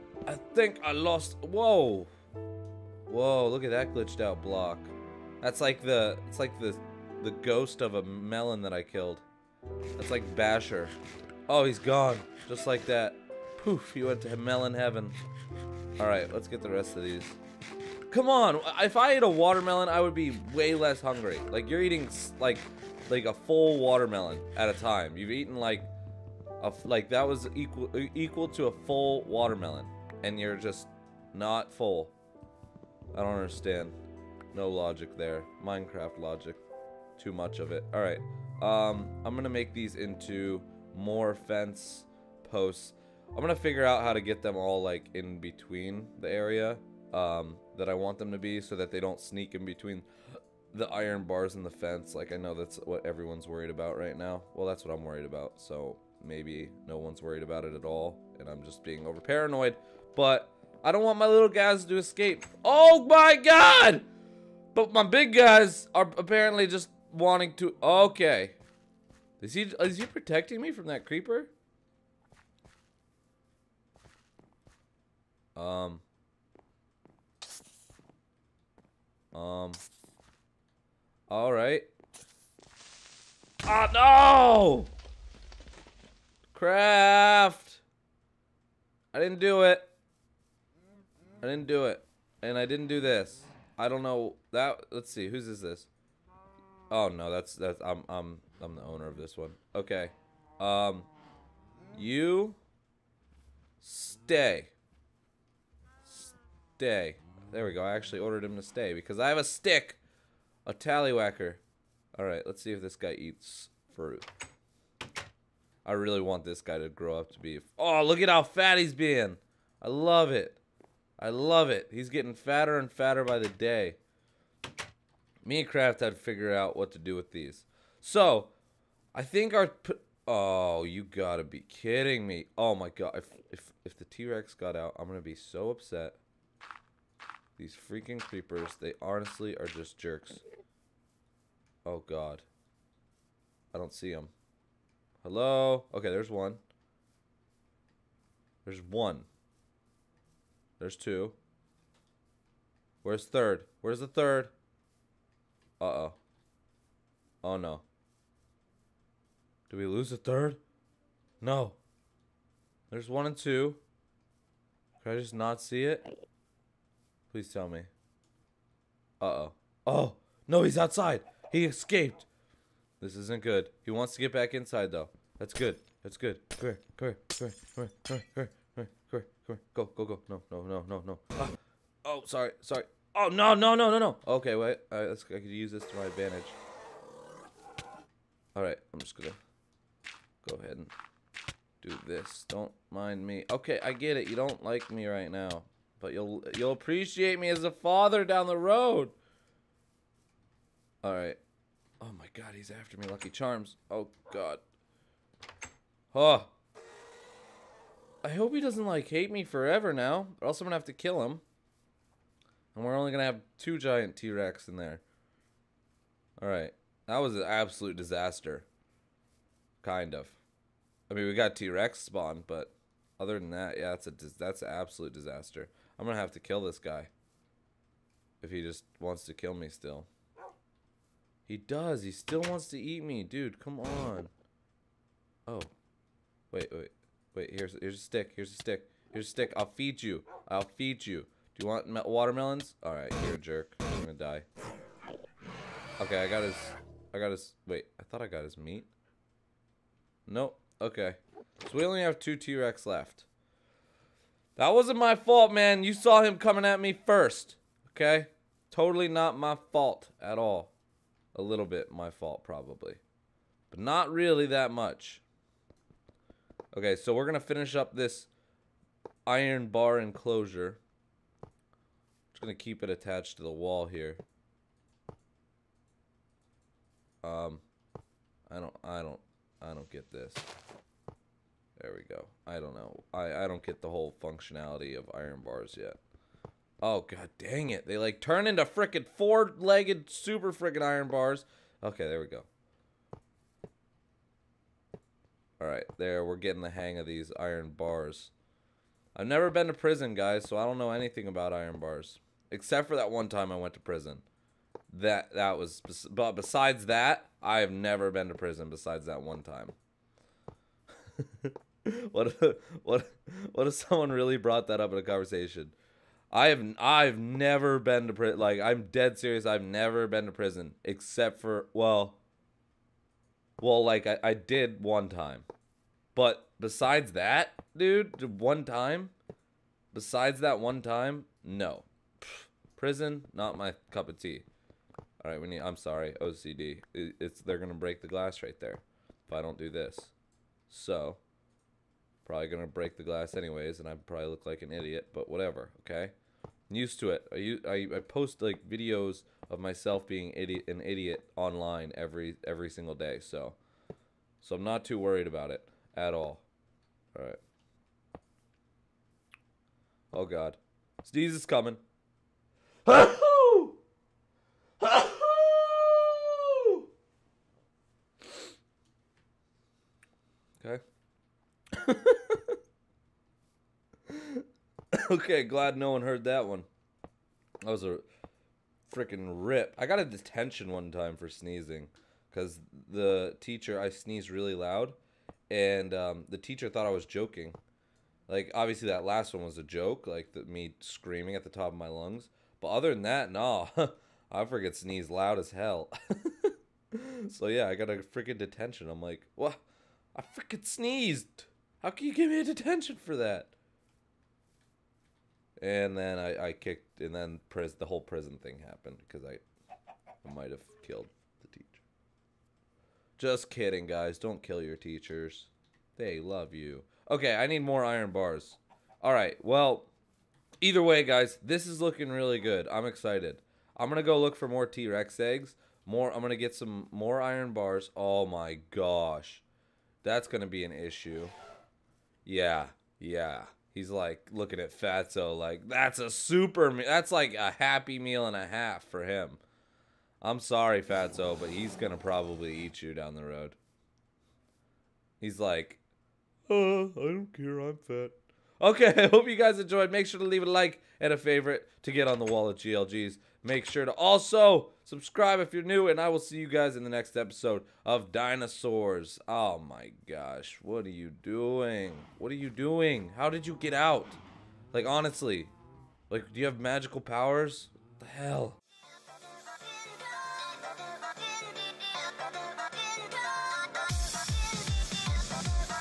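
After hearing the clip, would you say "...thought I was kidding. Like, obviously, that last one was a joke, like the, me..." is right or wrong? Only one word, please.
wrong.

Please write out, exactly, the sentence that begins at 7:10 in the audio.
That's going to be an issue.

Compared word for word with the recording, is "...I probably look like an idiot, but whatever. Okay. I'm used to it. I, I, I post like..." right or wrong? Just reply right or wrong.
right.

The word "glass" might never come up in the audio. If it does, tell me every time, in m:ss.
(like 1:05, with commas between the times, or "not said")
5:38, 5:43.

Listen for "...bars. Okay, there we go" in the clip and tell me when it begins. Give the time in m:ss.
4:51.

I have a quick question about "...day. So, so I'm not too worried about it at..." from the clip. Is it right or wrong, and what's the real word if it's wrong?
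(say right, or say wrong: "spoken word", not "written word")
right.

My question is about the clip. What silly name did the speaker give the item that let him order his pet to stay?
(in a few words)
tallywhacker.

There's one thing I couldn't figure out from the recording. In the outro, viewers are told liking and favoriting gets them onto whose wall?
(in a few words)
GLGs.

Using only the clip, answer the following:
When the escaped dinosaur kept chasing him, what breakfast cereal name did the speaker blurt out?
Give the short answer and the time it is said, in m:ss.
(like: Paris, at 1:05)
Lucky Charms, at 3:23.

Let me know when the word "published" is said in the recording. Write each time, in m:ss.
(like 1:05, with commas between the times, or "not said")
not said.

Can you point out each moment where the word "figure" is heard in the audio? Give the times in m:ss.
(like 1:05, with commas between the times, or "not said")
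0:43, 2:06.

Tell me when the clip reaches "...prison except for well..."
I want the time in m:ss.
5:20.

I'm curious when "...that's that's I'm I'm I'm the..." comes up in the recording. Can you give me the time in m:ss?
1:37.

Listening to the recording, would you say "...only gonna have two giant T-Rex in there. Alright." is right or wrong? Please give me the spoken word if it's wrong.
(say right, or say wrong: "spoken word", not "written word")
right.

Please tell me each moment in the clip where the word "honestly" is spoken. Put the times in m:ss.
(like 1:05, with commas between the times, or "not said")
2:19, 7:44.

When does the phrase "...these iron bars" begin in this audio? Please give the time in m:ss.
4:57.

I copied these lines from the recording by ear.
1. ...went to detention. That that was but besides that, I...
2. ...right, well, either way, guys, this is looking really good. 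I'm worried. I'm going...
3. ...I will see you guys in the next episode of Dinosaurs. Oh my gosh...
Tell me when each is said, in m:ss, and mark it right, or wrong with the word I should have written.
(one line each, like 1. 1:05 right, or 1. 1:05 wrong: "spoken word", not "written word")
1. 5:03 wrong: "prison", not "detention"
2. 6:59 wrong: "excited", not "worried"
3. 7:35 right.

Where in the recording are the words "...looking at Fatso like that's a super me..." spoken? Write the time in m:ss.
7:14.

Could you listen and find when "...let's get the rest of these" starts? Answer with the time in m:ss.
0:16.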